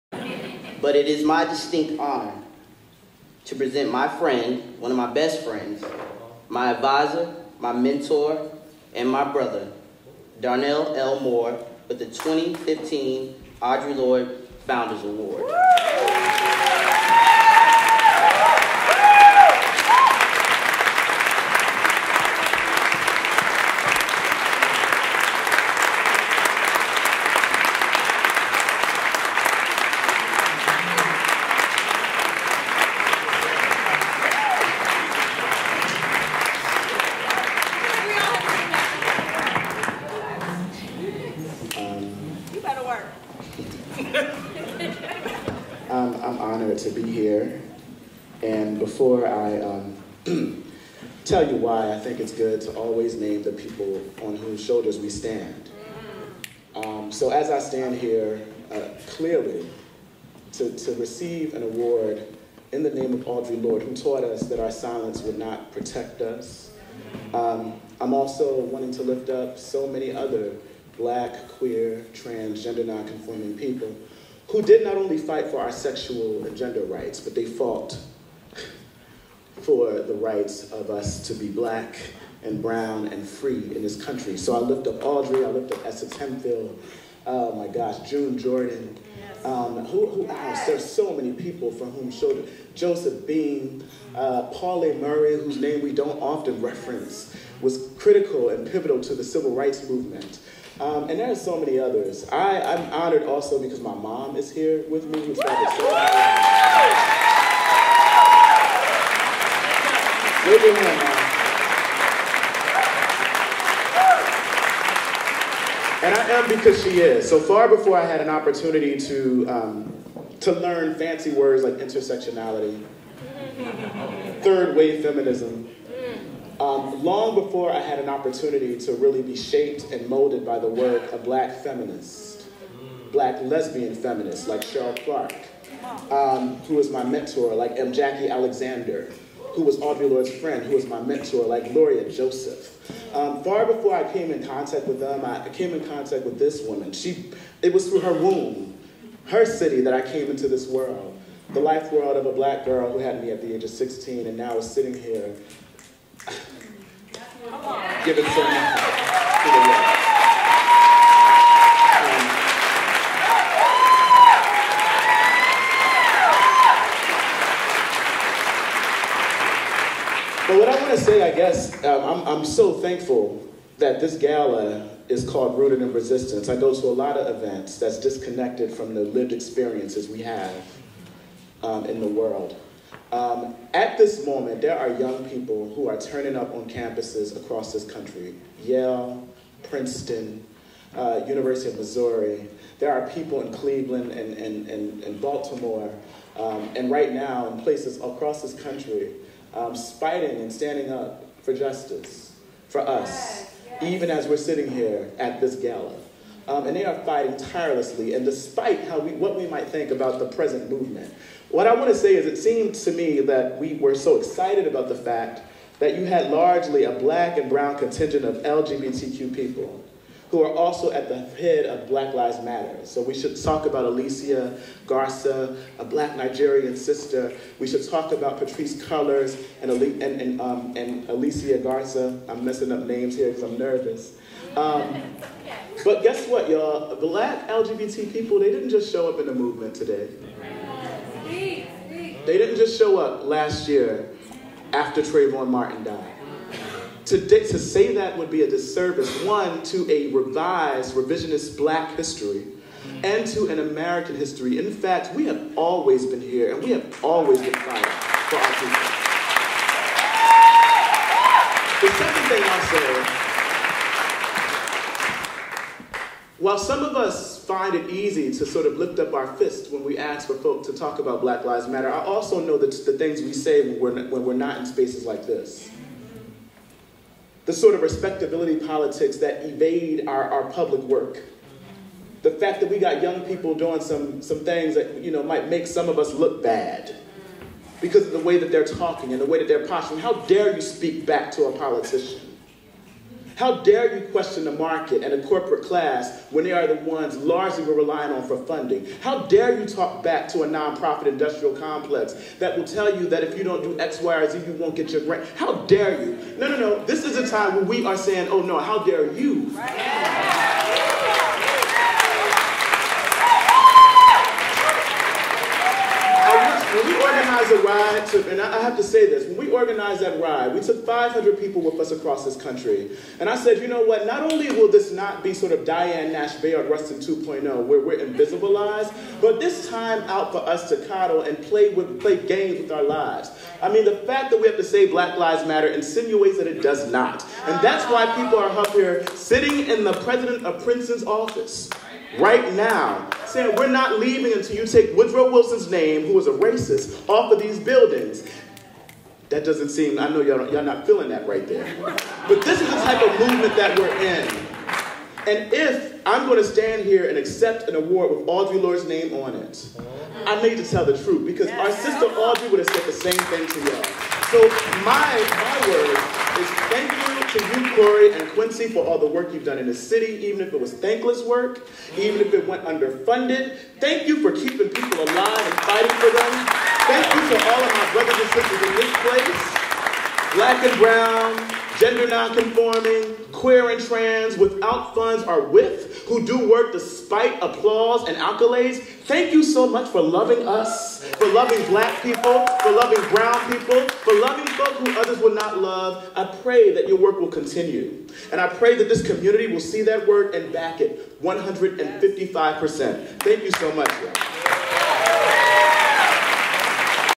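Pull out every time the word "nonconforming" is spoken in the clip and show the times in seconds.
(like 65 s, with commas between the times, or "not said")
72 s, 382 s.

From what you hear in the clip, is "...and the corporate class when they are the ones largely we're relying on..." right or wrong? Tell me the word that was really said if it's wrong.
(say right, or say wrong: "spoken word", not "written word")
right.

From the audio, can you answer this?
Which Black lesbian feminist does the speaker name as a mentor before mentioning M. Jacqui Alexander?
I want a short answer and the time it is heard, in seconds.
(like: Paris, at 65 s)
Cheryl Clarke, at 134 s.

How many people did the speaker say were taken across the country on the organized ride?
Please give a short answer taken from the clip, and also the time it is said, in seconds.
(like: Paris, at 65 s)
500, at 320 s.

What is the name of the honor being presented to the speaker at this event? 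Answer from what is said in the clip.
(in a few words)
2015 Audre Lorde Founders Award.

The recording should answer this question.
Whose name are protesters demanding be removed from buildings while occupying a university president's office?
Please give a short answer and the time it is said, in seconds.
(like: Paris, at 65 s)
Woodrow Wilson, at 344 s.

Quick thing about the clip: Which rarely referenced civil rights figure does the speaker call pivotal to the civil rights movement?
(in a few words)
Pauli Murray.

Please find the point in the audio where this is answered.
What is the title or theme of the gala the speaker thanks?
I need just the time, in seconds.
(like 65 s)
175 s.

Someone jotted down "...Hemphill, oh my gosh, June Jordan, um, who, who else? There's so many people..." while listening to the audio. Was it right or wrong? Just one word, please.
right.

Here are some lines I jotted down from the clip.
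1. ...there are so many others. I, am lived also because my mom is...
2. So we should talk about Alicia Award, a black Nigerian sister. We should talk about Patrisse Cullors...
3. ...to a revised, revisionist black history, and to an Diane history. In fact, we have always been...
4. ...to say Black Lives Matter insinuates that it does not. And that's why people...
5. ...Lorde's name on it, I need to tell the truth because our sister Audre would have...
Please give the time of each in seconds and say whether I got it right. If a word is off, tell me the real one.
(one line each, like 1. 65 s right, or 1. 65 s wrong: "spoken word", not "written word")
1. 101 s wrong: "honored", not "lived"
2. 222 s wrong: "Garza", not "Award"
3. 249 s wrong: "American", not "Diane"
4. 334 s right
5. 358 s right.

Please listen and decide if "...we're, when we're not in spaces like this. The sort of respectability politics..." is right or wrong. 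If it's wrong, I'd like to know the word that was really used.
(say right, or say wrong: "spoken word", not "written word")
right.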